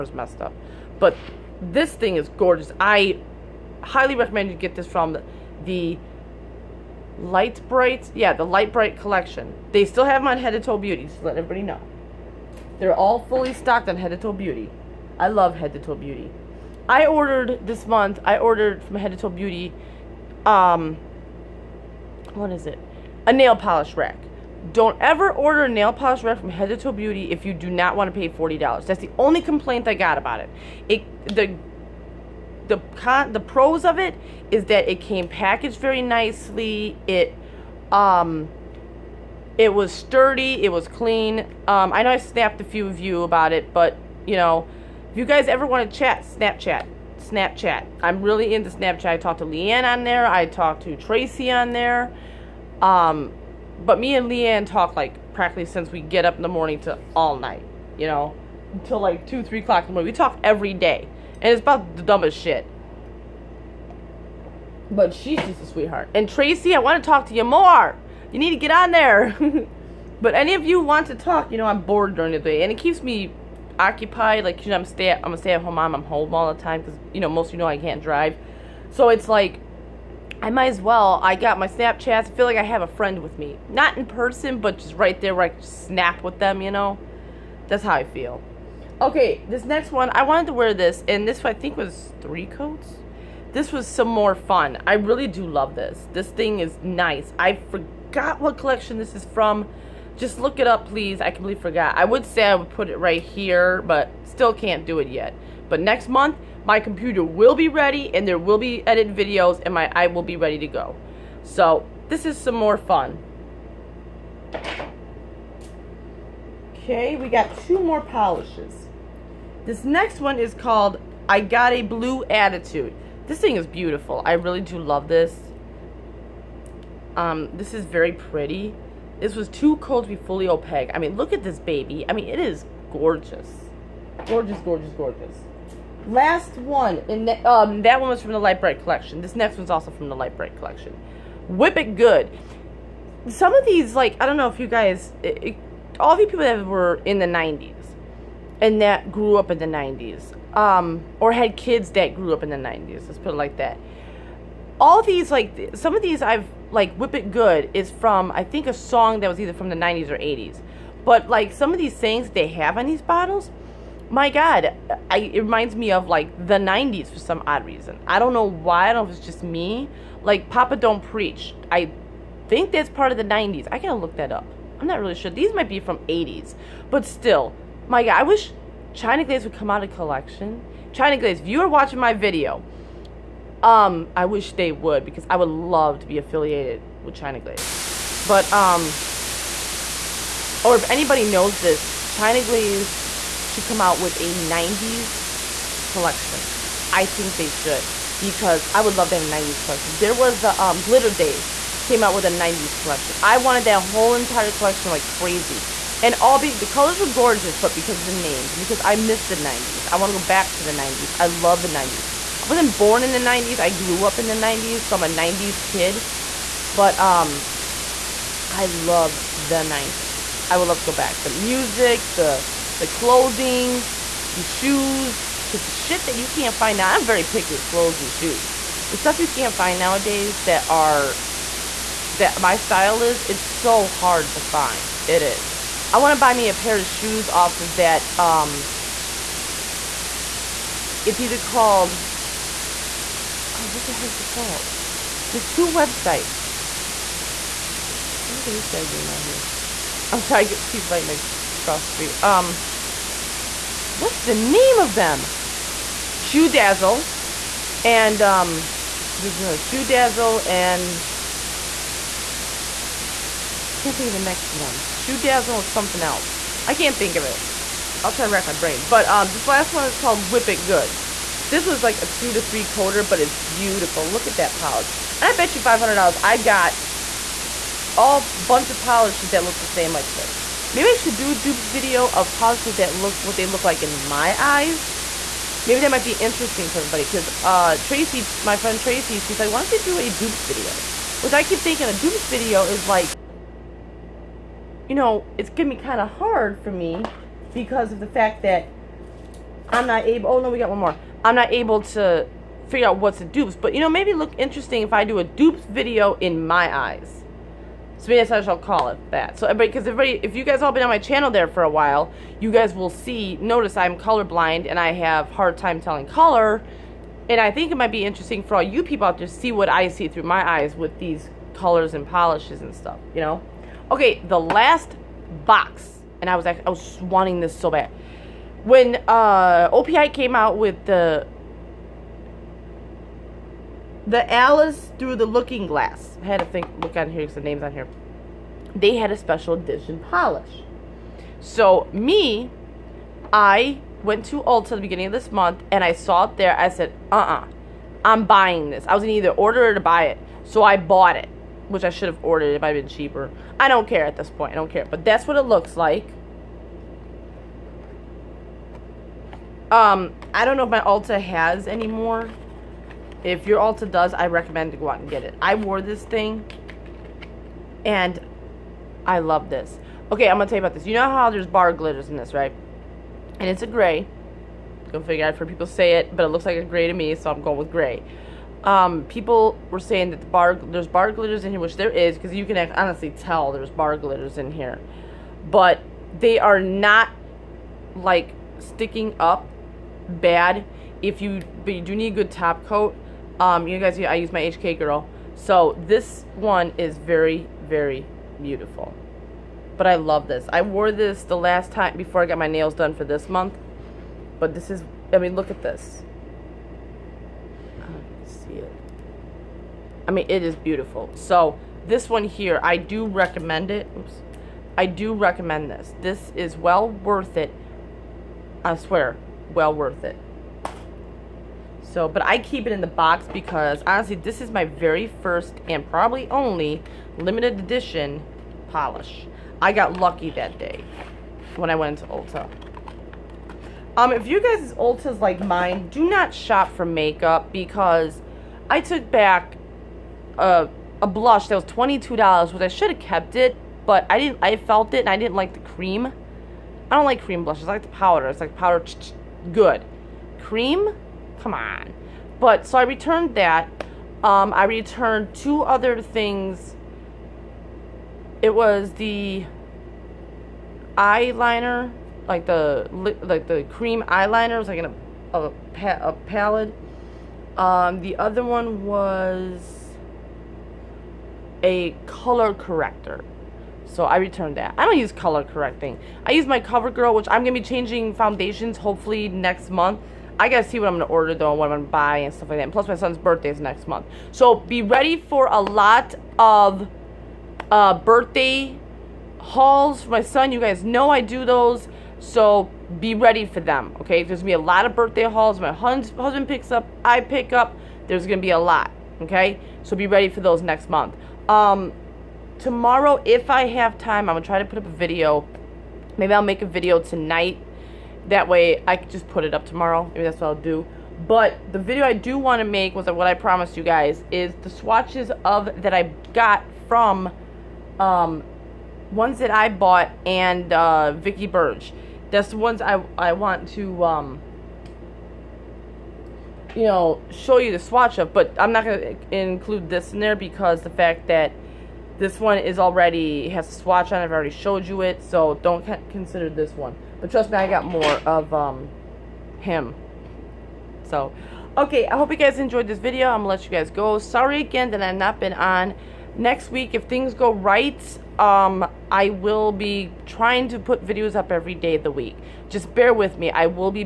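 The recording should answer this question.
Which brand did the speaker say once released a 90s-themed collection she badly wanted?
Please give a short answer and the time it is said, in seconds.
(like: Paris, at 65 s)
Glitter Days, at 200 s.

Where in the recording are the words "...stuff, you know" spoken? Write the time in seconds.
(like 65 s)
322 s.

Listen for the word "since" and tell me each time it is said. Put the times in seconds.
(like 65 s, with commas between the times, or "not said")
55 s.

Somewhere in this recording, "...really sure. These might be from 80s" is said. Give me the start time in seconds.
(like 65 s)
174 s.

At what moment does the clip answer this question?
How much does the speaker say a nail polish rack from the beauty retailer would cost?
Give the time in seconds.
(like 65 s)
28 s.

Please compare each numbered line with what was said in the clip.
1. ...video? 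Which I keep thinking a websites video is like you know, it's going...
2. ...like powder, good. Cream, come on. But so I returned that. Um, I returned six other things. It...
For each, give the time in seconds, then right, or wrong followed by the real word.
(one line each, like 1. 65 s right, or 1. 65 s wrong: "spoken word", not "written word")
1. 290 s wrong: "dupes", not "websites"
2. 448 s wrong: "two", not "six".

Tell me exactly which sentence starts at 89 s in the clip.
Okay, this next one, I wanted to wear this, and this I think was three coats.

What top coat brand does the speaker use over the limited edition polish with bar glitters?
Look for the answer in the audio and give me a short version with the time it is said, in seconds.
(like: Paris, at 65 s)
HK Girl, at 394 s.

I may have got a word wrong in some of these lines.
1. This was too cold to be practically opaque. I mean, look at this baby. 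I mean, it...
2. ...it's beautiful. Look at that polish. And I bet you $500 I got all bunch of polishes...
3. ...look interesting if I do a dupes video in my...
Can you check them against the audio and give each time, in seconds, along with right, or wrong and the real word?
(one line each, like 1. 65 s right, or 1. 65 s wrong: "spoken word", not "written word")
1. 129 s wrong: "fully", not "practically"
2. 273 s right
3. 304 s right.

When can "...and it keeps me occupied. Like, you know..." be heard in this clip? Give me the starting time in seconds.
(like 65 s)
72 s.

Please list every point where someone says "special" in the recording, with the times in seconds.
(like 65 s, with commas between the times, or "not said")
339 s.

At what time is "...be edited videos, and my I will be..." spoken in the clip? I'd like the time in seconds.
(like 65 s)
108 s.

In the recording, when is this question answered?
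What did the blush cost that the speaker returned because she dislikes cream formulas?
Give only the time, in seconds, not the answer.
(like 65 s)
441 s.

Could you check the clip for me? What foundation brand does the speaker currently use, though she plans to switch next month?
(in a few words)
CoverGirl.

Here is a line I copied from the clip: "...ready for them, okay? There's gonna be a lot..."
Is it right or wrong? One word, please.
right.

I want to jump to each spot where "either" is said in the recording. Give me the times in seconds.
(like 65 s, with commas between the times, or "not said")
159 s, 241 s, 349 s.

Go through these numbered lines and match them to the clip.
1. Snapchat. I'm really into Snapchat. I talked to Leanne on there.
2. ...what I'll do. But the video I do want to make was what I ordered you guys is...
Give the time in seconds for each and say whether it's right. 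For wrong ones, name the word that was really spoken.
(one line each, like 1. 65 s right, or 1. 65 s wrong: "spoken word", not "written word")
1. 47 s right
2. 510 s wrong: "promised", not "ordered".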